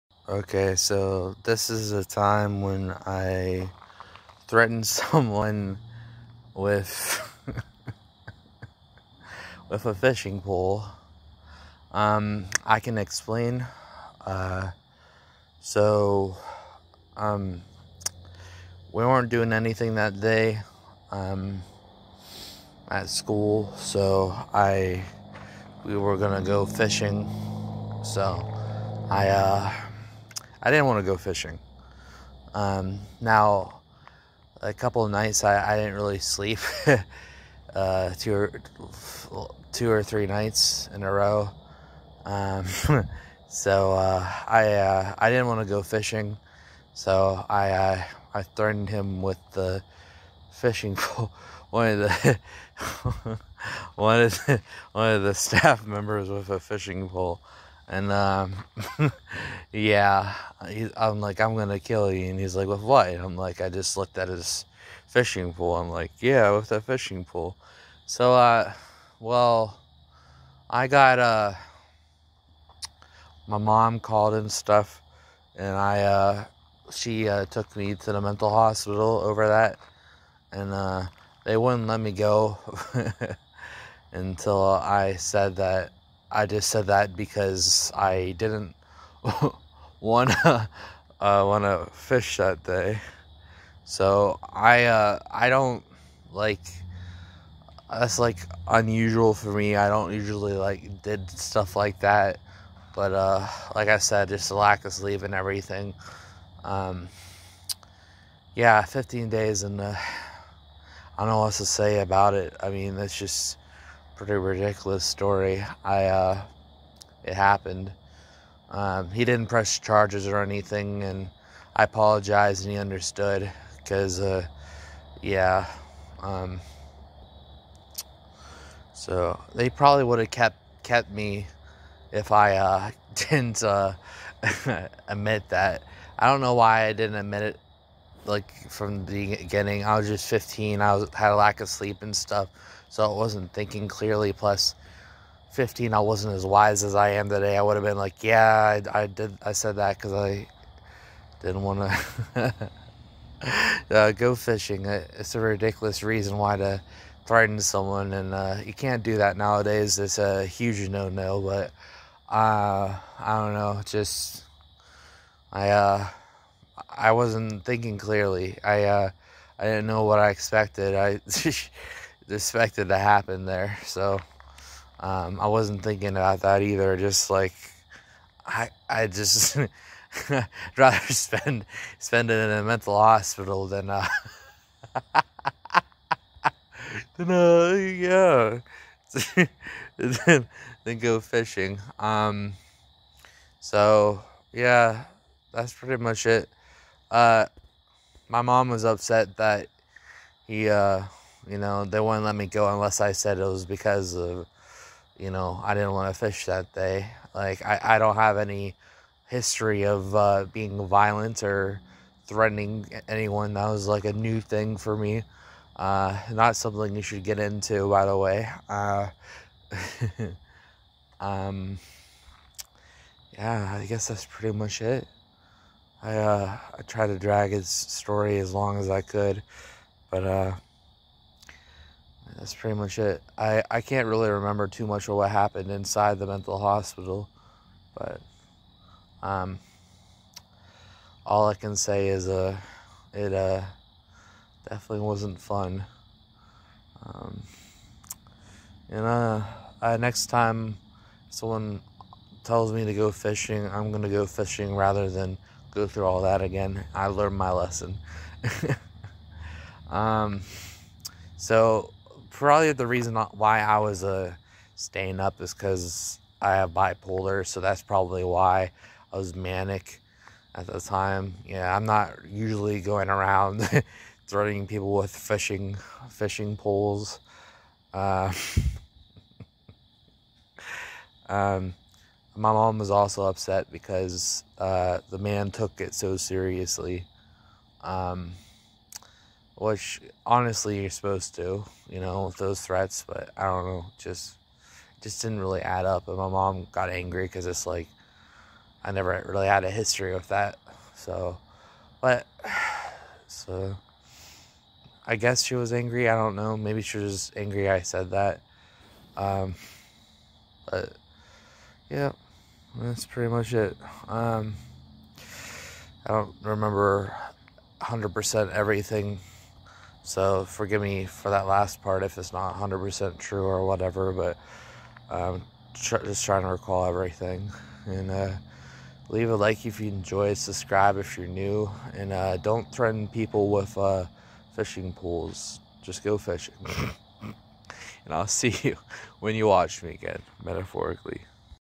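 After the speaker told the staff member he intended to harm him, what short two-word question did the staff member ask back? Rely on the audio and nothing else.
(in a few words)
With what?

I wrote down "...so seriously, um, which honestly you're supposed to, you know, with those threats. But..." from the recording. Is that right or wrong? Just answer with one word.
right.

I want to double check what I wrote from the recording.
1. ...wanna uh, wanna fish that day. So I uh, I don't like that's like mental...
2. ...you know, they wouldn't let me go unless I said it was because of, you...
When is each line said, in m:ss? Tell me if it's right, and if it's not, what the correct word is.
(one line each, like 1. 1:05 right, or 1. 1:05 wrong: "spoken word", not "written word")
1. 1:29 wrong: "unusual", not "mental"
2. 3:21 right.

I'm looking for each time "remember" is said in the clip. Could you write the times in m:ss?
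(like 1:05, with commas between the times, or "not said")
3:54, 5:16.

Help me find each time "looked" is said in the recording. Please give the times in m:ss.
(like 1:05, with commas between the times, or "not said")
1:03.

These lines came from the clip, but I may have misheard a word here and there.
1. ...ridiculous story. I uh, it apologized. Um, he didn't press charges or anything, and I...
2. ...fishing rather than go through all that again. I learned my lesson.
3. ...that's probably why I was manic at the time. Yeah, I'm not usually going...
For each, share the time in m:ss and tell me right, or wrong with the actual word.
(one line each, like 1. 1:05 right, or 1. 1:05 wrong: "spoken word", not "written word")
1. 1:54 wrong: "happened", not "apologized"
2. 4:14 right
3. 4:27 right.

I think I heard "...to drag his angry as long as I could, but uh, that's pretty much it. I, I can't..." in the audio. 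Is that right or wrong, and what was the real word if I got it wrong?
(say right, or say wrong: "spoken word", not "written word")
wrong: "story", not "angry".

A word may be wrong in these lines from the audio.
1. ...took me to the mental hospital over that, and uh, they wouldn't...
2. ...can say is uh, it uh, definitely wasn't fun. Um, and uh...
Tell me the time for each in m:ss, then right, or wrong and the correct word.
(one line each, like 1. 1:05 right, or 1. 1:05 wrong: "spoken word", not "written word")
1. 1:17 right
2. 4:01 right.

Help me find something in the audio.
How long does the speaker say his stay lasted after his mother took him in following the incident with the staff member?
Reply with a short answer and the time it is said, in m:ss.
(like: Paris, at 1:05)
15 days, at 1:48.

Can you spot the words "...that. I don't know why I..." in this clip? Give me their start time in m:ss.
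2:15.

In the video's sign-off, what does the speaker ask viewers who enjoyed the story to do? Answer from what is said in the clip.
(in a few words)
Leave a like.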